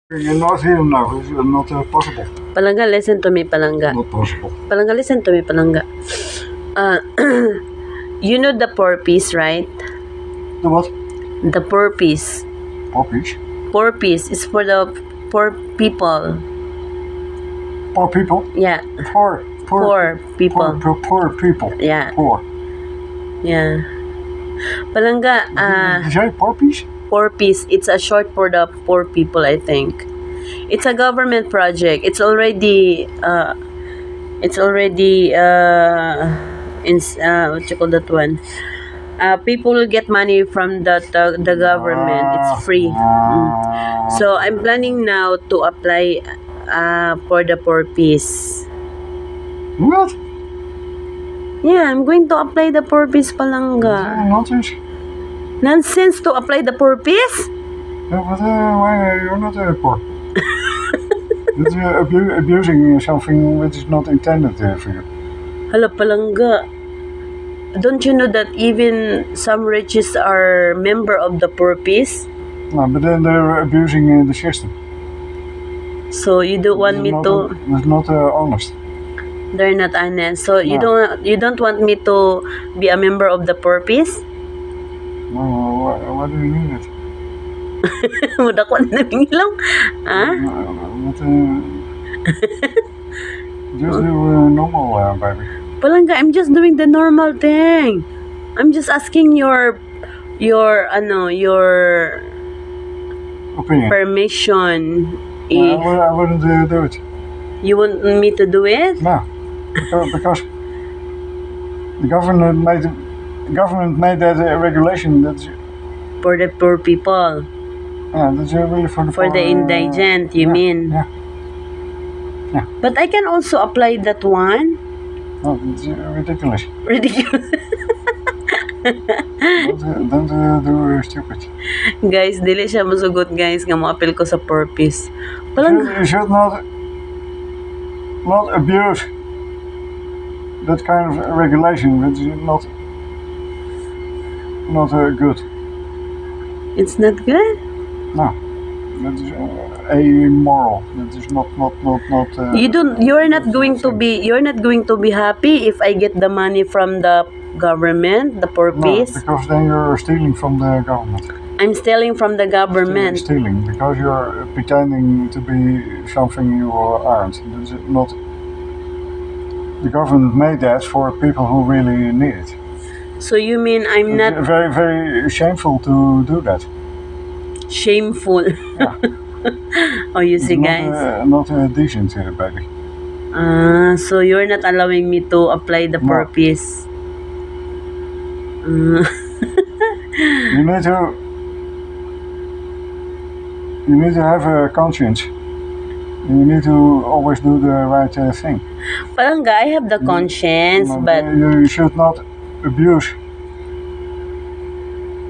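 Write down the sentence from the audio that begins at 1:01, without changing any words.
you uh, abu abusing something which is not intended uh, for you.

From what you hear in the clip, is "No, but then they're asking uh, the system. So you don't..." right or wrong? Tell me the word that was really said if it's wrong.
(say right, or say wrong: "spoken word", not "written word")
wrong: "abusing", not "asking".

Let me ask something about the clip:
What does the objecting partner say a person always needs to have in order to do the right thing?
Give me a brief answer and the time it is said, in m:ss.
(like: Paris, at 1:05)
a conscience, at 3:14.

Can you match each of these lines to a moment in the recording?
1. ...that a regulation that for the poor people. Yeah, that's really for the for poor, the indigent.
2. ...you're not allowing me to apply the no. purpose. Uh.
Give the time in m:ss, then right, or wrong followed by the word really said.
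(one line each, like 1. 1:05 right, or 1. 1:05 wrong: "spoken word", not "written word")
1. 1:54 right
2. 3:04 right.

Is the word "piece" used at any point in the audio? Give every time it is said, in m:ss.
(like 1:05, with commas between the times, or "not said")
0:47, 0:53.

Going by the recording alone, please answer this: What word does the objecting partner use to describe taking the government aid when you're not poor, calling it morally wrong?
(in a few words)
immoral.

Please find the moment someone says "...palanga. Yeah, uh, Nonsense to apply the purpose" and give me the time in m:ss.
0:53.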